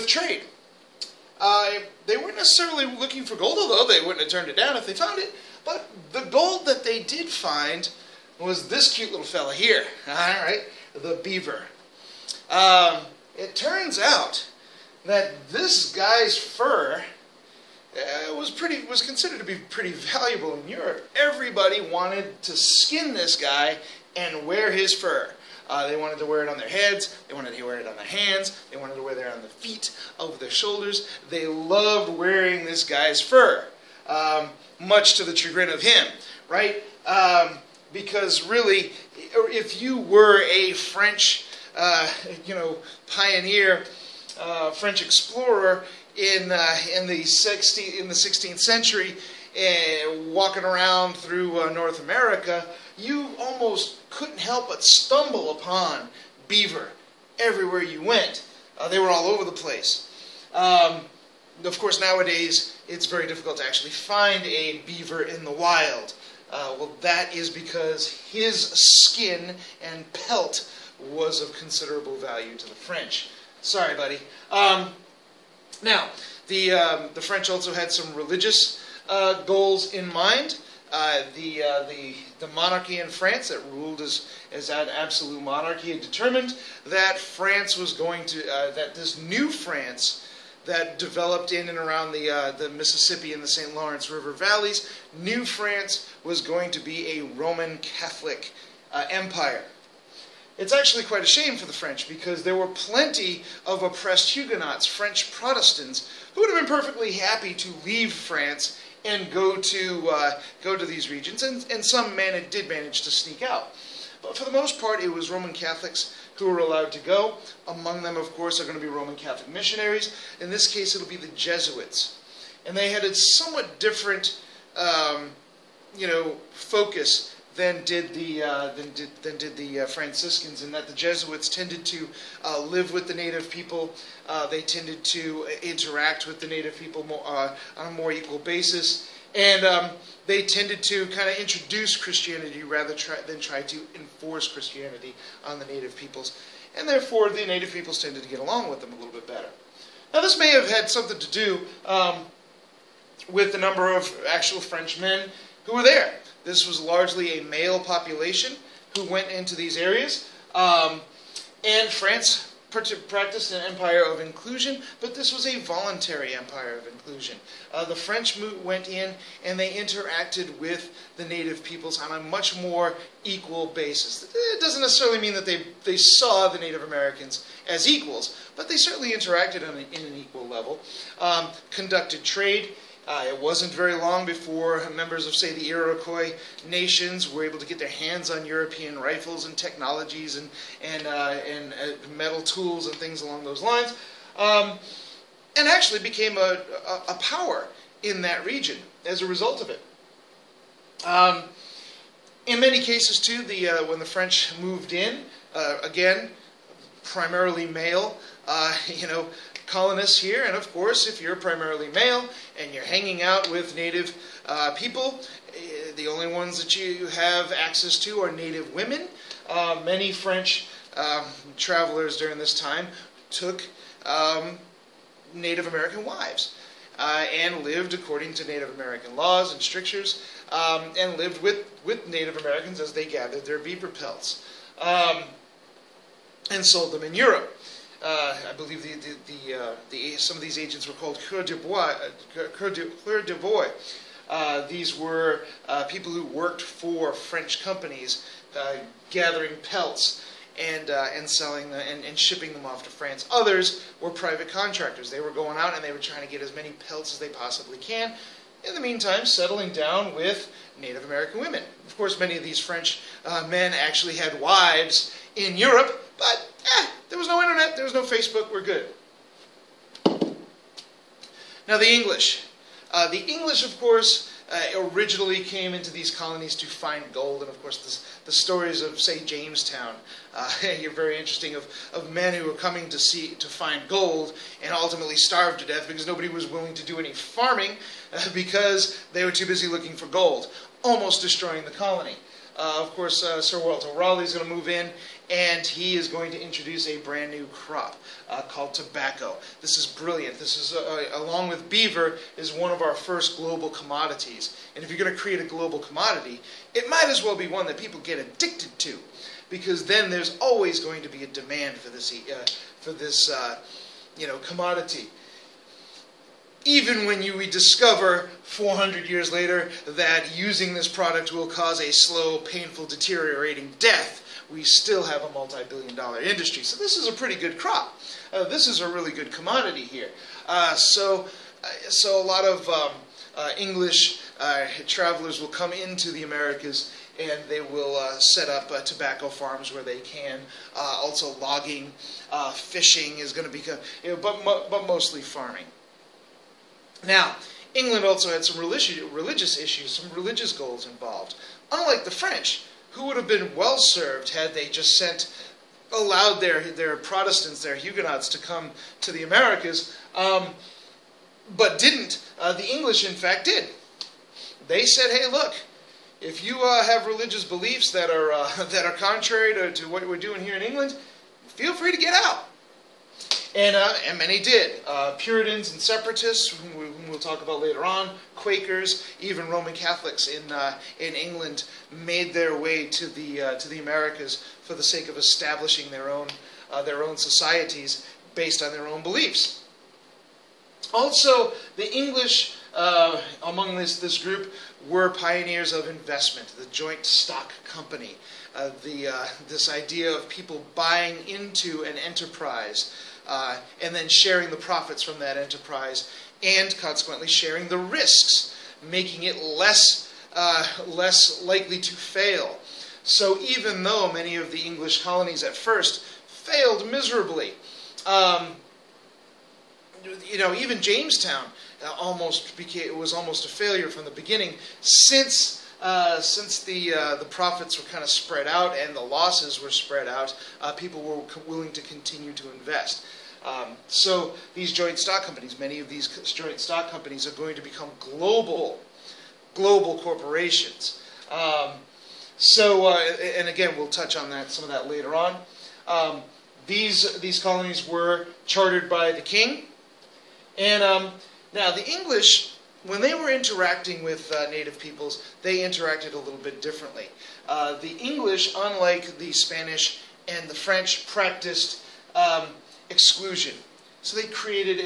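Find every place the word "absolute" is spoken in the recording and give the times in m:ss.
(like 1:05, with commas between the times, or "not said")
1:24.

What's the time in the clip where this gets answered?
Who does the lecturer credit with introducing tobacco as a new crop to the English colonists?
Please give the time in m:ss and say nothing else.
4:53.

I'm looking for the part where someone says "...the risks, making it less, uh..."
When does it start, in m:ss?
6:47.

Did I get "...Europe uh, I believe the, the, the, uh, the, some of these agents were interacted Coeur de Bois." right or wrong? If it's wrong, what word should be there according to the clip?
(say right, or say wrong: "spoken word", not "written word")
wrong: "called", not "interacted".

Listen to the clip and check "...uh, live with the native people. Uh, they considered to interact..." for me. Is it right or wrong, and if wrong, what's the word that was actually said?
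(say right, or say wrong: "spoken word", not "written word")
wrong: "tended", not "considered".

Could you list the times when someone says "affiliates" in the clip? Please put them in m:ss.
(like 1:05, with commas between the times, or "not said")
not said.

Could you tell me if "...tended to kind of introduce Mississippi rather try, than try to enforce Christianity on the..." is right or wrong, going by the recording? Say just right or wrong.
wrong.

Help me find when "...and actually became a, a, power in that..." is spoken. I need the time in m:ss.
3:15.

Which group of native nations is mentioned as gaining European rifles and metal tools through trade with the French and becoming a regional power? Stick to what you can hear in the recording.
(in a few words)
Iroquois.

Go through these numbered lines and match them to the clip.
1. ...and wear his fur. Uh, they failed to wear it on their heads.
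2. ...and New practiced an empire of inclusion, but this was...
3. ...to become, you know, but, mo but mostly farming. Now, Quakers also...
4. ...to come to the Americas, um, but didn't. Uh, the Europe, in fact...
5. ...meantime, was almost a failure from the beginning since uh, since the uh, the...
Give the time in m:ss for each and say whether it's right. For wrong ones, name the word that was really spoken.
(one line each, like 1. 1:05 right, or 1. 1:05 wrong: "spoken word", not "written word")
1. 0:24 wrong: "wanted", not "failed"
2. 2:41 wrong: "France", not "New"
3. 5:43 wrong: "England", not "Quakers"
4. 5:58 wrong: "English", not "Europe"
5. 7:02 wrong: "became", not "meantime".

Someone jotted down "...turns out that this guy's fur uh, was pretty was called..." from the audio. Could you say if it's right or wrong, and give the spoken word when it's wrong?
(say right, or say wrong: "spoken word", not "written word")
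wrong: "considered", not "called".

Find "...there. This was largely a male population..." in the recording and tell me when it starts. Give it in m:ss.
2:35.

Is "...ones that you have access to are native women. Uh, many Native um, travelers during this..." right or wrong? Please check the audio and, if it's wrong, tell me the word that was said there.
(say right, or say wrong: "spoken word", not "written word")
wrong: "French", not "Native".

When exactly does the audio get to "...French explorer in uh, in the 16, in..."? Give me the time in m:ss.
0:44.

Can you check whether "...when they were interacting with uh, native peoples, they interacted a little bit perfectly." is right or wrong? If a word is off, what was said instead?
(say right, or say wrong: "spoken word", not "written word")
wrong: "differently", not "perfectly".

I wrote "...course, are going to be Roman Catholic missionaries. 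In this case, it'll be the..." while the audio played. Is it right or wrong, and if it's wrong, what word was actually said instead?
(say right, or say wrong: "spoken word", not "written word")
right.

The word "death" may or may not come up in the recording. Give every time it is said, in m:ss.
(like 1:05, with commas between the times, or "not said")
4:45, 5:23.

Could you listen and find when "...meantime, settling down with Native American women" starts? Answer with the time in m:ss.
4:18.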